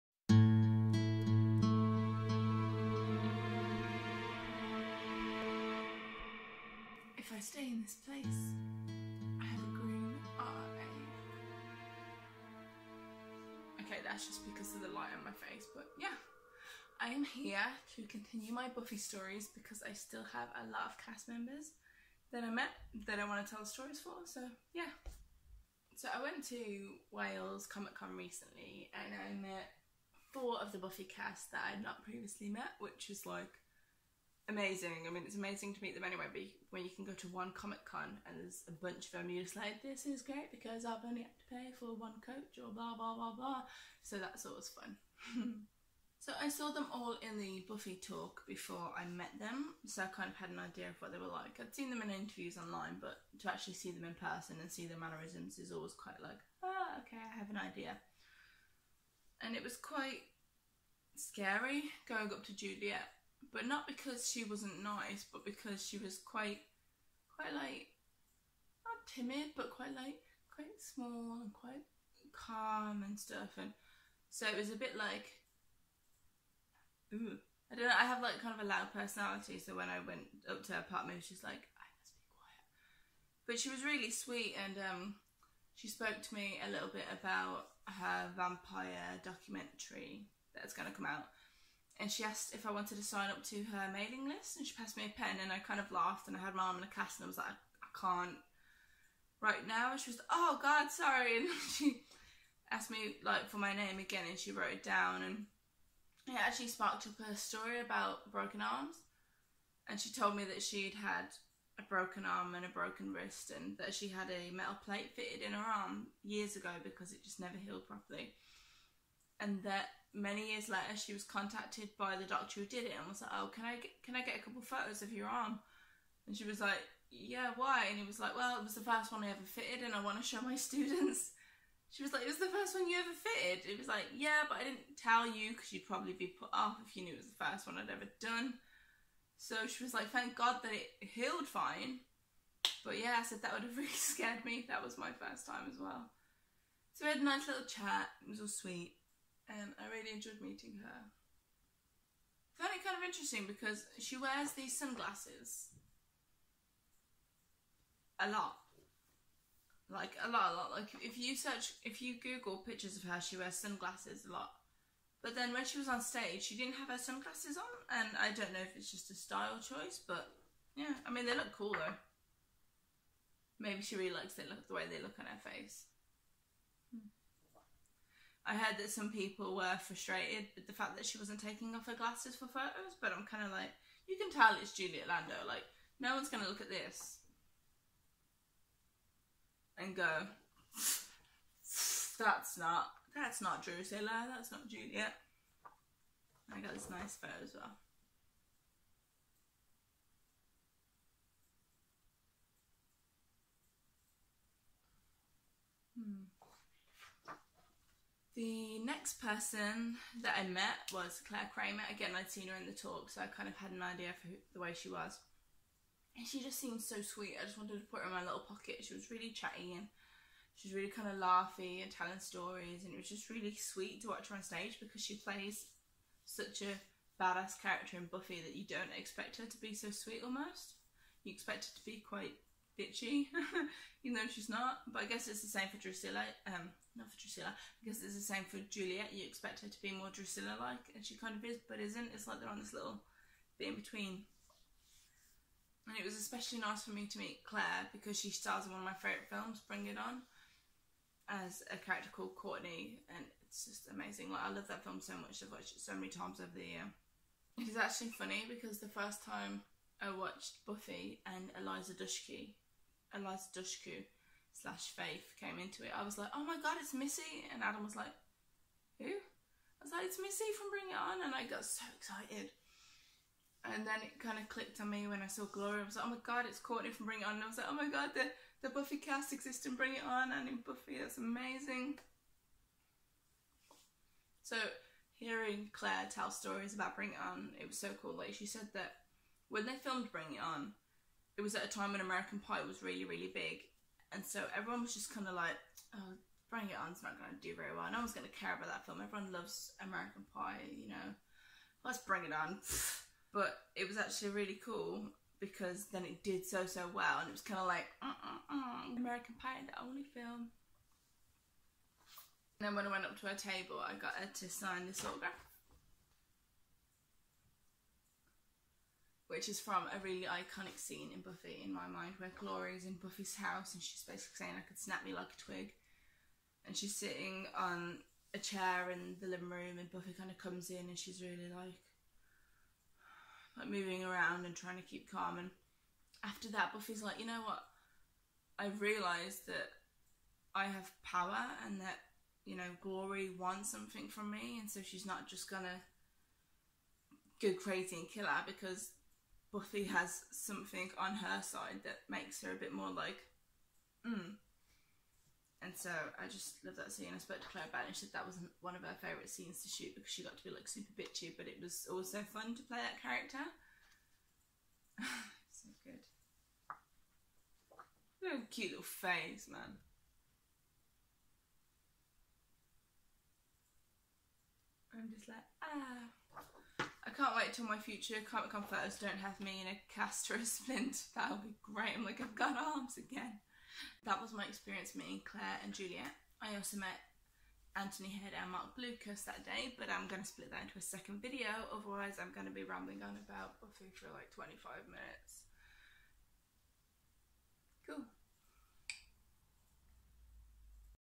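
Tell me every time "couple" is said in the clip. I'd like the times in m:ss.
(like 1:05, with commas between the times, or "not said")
2:04.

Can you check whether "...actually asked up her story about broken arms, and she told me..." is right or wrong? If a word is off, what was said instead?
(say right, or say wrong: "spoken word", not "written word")
wrong: "sparked", not "asked".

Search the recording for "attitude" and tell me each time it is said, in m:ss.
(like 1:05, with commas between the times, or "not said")
not said.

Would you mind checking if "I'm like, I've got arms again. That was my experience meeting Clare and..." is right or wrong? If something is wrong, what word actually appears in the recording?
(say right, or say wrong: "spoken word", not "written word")
right.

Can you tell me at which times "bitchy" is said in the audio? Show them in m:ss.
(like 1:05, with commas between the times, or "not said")
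3:52, 6:00.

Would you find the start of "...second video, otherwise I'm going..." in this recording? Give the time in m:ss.
6:30.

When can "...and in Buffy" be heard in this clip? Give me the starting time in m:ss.
4:40.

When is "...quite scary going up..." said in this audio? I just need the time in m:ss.
0:59.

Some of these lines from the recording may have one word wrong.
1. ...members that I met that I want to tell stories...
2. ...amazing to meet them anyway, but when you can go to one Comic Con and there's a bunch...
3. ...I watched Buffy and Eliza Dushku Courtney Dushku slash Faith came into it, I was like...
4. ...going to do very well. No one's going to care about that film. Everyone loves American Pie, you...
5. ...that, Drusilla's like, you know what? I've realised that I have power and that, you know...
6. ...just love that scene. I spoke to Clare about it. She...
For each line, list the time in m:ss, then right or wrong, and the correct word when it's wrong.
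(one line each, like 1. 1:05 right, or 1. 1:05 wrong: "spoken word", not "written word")
1. 0:21 right
2. 0:35 right
3. 4:20 wrong: "Eliza", not "Courtney"
4. 4:57 right
5. 5:36 wrong: "Buffy", not "Drusilla"
6. 5:56 right.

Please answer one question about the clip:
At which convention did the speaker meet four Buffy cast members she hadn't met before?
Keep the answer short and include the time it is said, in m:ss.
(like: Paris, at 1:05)
Wales Comic Con, at 0:27.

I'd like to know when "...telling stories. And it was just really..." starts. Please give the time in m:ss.
3:41.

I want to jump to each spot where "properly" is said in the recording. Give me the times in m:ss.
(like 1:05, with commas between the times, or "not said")
1:57.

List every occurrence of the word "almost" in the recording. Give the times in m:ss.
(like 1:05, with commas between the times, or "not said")
3:50.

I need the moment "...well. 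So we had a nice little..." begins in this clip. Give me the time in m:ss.
2:25.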